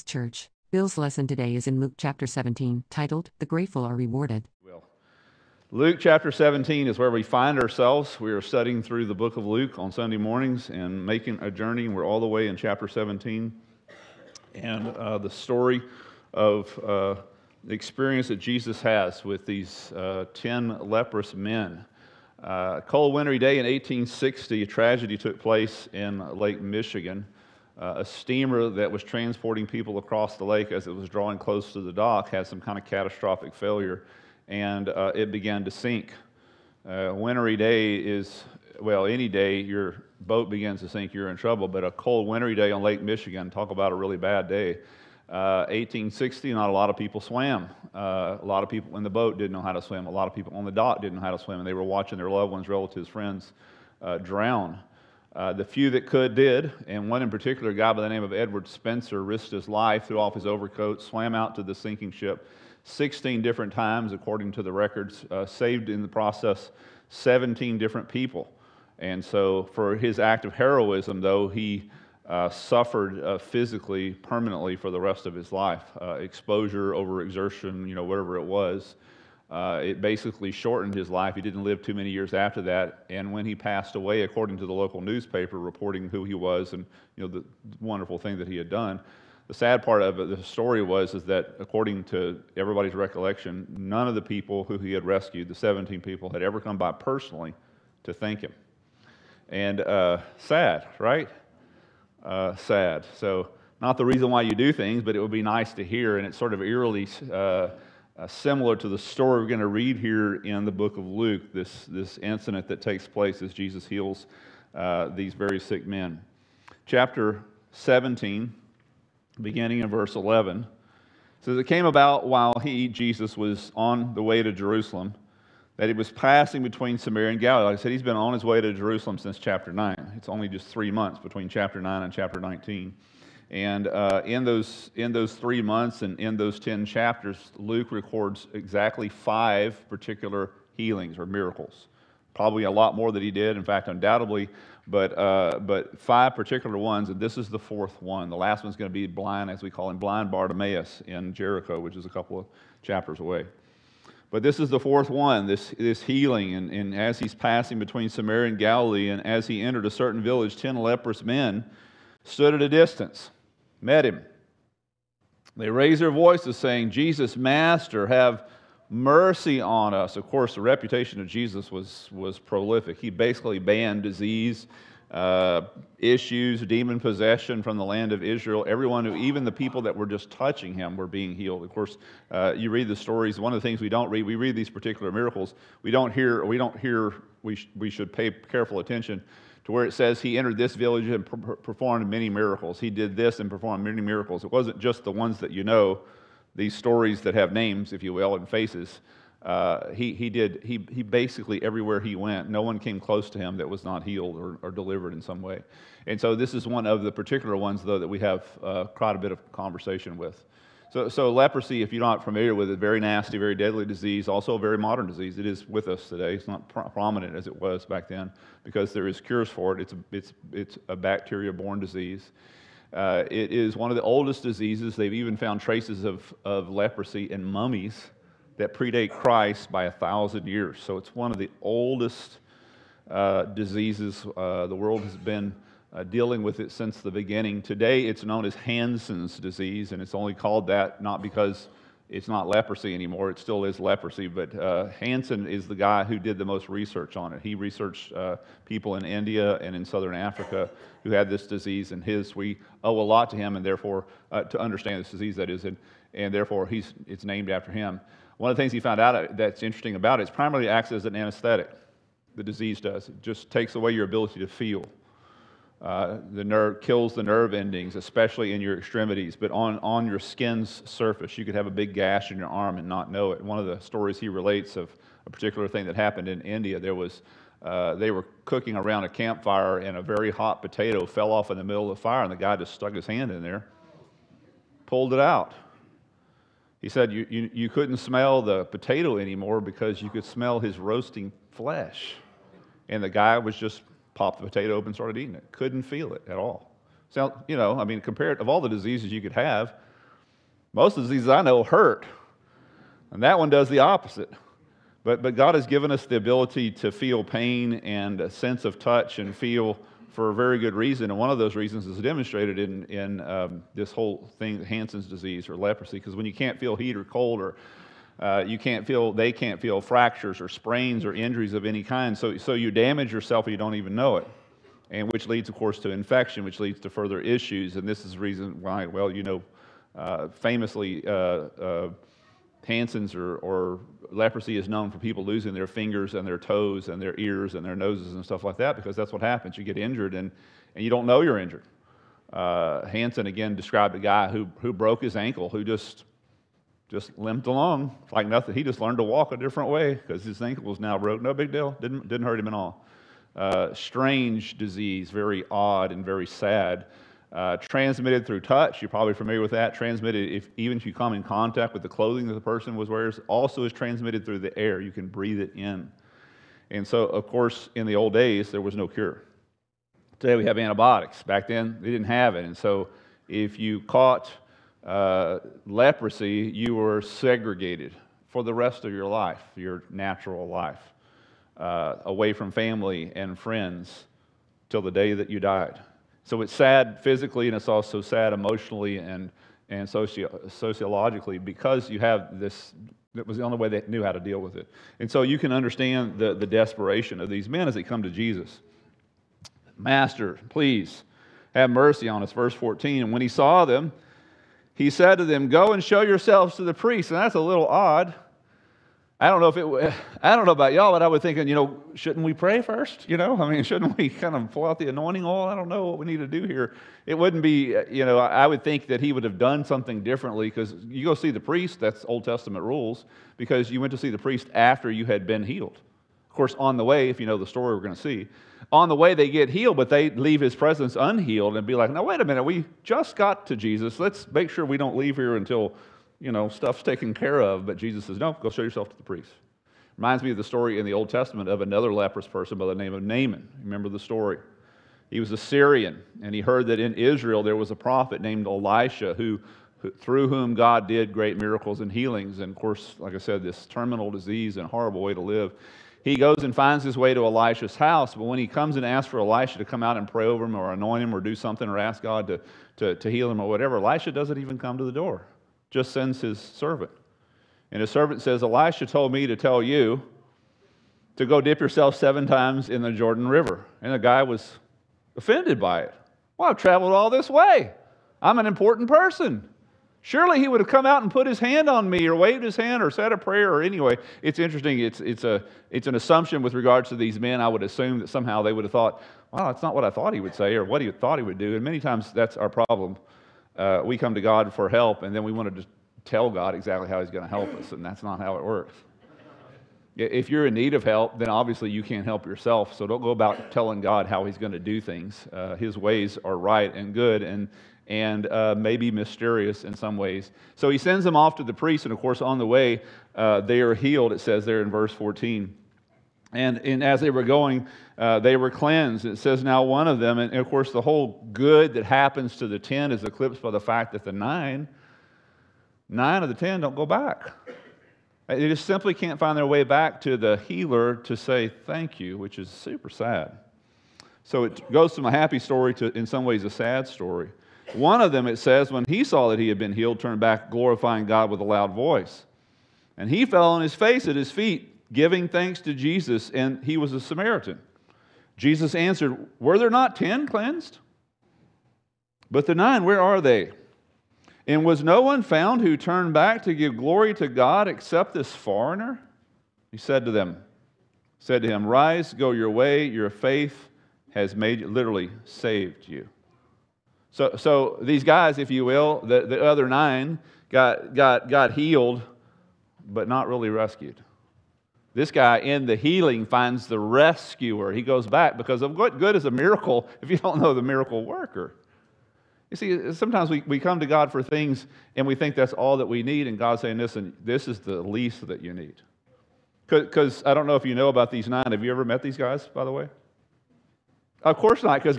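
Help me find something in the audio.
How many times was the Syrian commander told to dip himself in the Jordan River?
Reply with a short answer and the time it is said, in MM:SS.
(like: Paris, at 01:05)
7, at 07:51.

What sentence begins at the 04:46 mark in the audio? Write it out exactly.
He said you, you, you couldn't smell the potato anymore because you could smell his roasting flesh.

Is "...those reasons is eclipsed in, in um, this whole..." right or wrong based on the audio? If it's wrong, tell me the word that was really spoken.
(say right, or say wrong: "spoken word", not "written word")
wrong: "demonstrated", not "eclipsed".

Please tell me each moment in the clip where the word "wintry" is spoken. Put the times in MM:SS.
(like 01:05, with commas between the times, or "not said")
00:23, 00:37, 00:42.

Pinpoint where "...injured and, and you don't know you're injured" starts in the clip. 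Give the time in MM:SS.
05:39.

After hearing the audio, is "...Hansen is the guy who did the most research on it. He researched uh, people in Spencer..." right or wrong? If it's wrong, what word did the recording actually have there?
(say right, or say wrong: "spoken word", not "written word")
wrong: "India", not "Spencer".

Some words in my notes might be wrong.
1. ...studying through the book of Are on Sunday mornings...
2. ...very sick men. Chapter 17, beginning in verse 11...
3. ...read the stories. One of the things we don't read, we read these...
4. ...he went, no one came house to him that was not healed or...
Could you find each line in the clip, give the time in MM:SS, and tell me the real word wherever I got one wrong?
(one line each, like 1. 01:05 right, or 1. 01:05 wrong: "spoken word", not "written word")
1. 00:08 wrong: "Luke", not "Are"
2. 01:55 right
3. 03:02 right
4. 03:21 wrong: "close", not "house".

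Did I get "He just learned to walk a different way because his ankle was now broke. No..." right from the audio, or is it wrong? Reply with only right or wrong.
right.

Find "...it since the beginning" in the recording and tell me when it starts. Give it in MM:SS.
03:56.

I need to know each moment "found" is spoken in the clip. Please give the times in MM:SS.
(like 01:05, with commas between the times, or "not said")
03:45, 04:18, 09:15.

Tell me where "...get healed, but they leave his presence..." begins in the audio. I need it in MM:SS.
07:09.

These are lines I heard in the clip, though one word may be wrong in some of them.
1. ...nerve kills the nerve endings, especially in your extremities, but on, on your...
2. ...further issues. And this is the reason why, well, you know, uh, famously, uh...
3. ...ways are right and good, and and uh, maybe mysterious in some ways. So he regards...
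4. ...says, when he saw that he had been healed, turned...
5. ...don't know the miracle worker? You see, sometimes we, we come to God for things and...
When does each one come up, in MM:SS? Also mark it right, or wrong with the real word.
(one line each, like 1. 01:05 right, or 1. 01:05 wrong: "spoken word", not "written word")
1. 04:26 right
2. 05:26 right
3. 08:25 wrong: "sends", not "regards"
4. 08:58 right
5. 09:40 right.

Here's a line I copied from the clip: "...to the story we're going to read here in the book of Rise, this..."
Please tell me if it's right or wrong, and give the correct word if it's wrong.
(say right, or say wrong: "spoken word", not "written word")
wrong: "Luke", not "Rise".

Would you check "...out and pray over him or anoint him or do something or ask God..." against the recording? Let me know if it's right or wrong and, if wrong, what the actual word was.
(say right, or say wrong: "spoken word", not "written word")
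right.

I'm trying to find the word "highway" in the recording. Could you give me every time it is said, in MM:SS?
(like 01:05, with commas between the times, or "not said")
not said.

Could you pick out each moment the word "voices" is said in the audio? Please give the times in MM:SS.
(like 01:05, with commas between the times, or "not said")
02:46, 09:01.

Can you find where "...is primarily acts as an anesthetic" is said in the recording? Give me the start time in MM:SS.
04:20.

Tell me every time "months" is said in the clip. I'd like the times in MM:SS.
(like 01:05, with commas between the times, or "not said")
02:10, 02:15.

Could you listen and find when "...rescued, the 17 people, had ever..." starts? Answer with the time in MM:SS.
01:35.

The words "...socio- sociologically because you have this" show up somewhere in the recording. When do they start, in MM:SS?
06:29.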